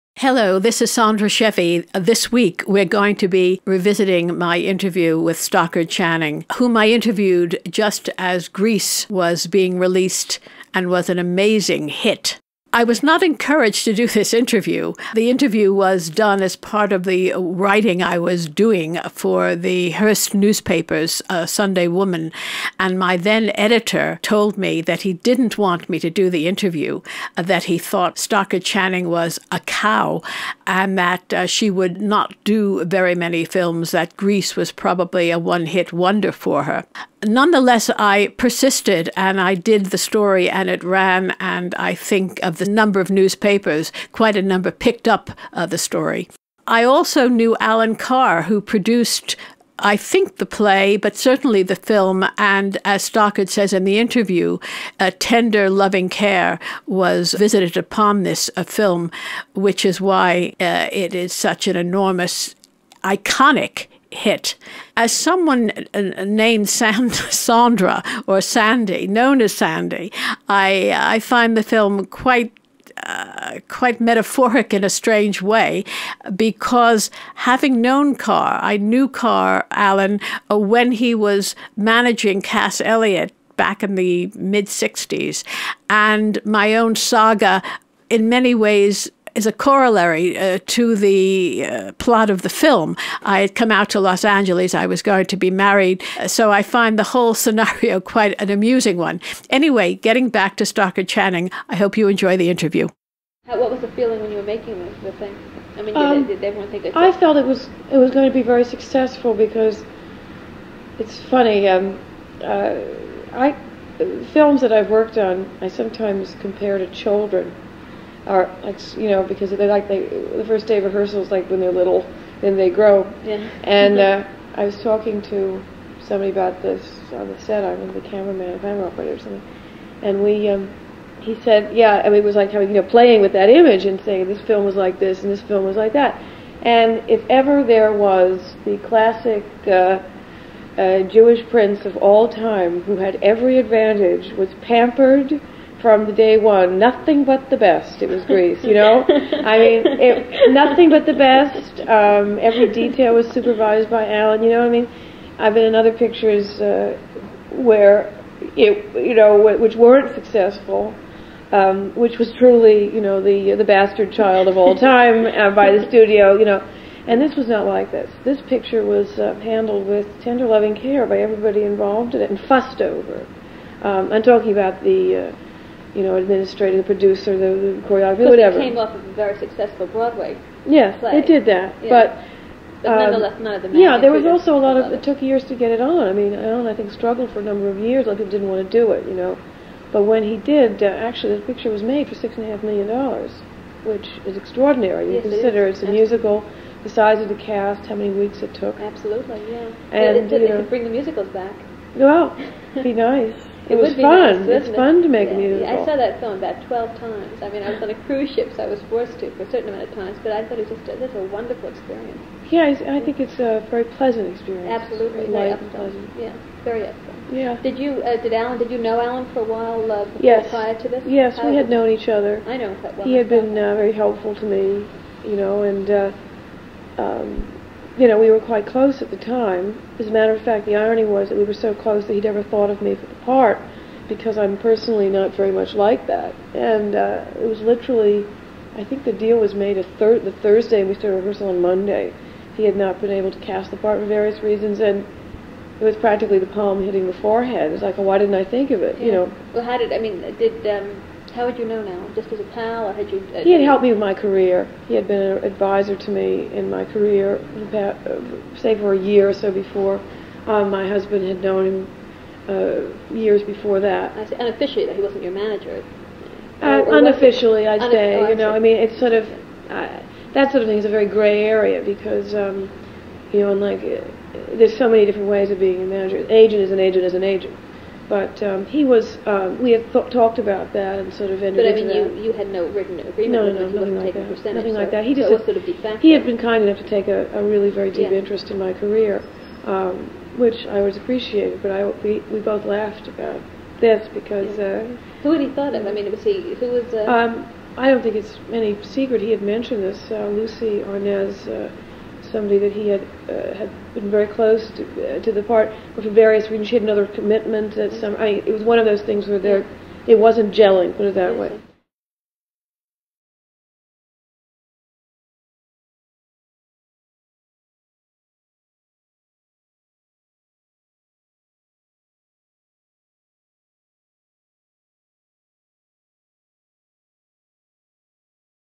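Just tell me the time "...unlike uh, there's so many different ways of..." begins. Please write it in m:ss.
4:33.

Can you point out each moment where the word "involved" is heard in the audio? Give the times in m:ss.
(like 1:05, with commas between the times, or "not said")
2:51.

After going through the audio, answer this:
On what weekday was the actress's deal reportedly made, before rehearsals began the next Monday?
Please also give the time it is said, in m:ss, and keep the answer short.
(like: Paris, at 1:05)
Thursday, at 4:00.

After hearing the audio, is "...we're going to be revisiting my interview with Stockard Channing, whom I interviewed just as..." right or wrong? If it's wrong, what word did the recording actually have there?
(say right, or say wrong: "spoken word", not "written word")
right.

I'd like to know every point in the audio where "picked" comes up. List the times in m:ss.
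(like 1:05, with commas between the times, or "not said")
0:44.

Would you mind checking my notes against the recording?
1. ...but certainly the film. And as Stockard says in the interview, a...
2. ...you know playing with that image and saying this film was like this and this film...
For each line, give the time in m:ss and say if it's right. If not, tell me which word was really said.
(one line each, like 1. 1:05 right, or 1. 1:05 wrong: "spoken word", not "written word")
1. 0:50 right
2. 2:12 right.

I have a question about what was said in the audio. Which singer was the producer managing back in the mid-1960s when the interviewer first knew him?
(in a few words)
Cass Elliot.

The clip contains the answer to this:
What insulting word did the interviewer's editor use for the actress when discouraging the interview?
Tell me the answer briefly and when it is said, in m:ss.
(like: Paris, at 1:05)
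cow, at 0:29.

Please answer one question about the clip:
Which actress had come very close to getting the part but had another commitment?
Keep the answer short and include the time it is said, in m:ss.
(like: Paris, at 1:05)
Lucie Arnaz, at 5:00.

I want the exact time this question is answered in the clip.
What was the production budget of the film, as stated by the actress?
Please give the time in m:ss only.
3:12.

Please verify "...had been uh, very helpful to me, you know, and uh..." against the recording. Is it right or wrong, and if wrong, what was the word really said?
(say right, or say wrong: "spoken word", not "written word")
right.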